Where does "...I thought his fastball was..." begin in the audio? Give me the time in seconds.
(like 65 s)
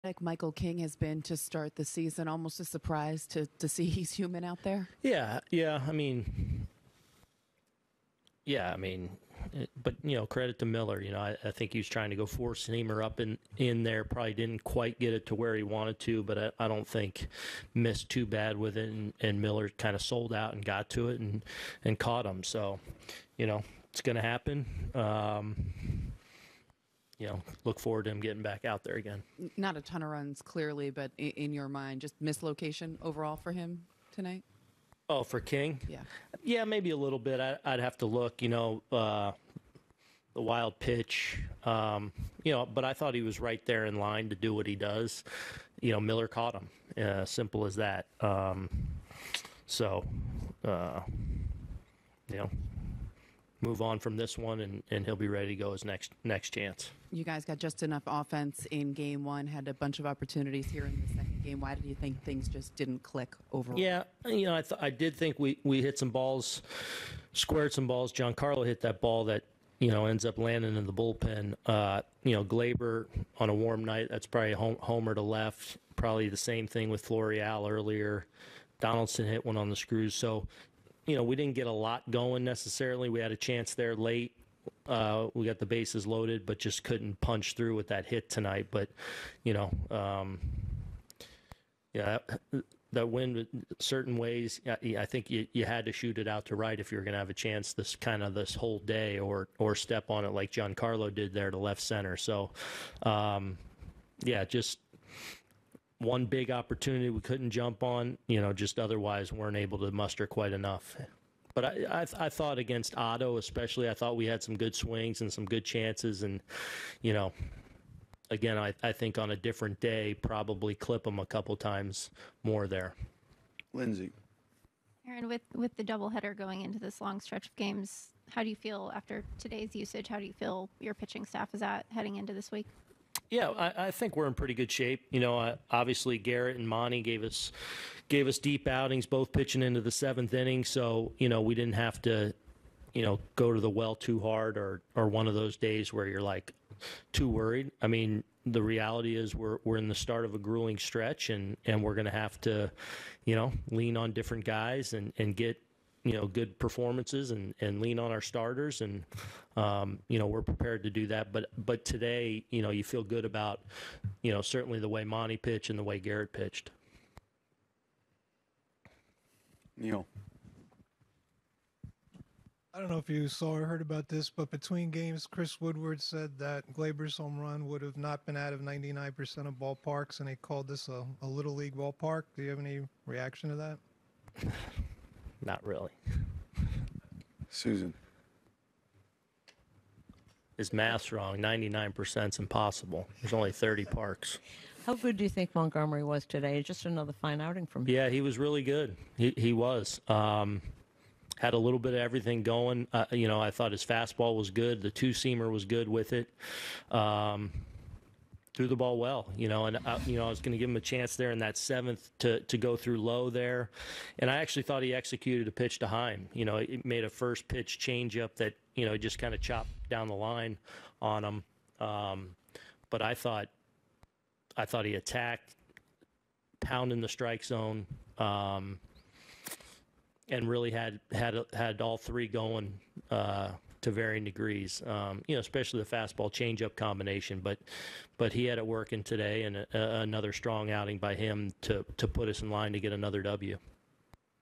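203 s.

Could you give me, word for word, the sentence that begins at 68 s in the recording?
Giancarlo hit that ball that, you know, ends up landing in the bullpen.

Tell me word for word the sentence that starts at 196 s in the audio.
Just another fine outing from him.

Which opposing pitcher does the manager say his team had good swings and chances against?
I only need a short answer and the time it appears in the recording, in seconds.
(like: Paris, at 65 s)
Otto, at 112 s.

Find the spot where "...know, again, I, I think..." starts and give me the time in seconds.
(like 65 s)
117 s.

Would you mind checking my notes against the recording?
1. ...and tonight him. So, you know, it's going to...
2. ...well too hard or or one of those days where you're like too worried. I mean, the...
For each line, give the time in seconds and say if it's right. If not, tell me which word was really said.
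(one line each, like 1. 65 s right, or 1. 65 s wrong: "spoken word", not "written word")
1. 21 s wrong: "caught", not "tonight"
2. 143 s right.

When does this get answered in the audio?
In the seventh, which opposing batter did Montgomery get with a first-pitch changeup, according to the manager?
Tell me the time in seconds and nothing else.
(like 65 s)
215 s.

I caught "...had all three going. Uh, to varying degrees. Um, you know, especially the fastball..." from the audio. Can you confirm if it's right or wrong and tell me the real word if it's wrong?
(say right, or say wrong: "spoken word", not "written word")
right.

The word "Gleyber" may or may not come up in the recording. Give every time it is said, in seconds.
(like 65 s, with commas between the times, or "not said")
72 s, 176 s.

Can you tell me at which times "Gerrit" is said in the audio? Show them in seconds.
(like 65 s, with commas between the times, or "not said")
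136 s, 165 s.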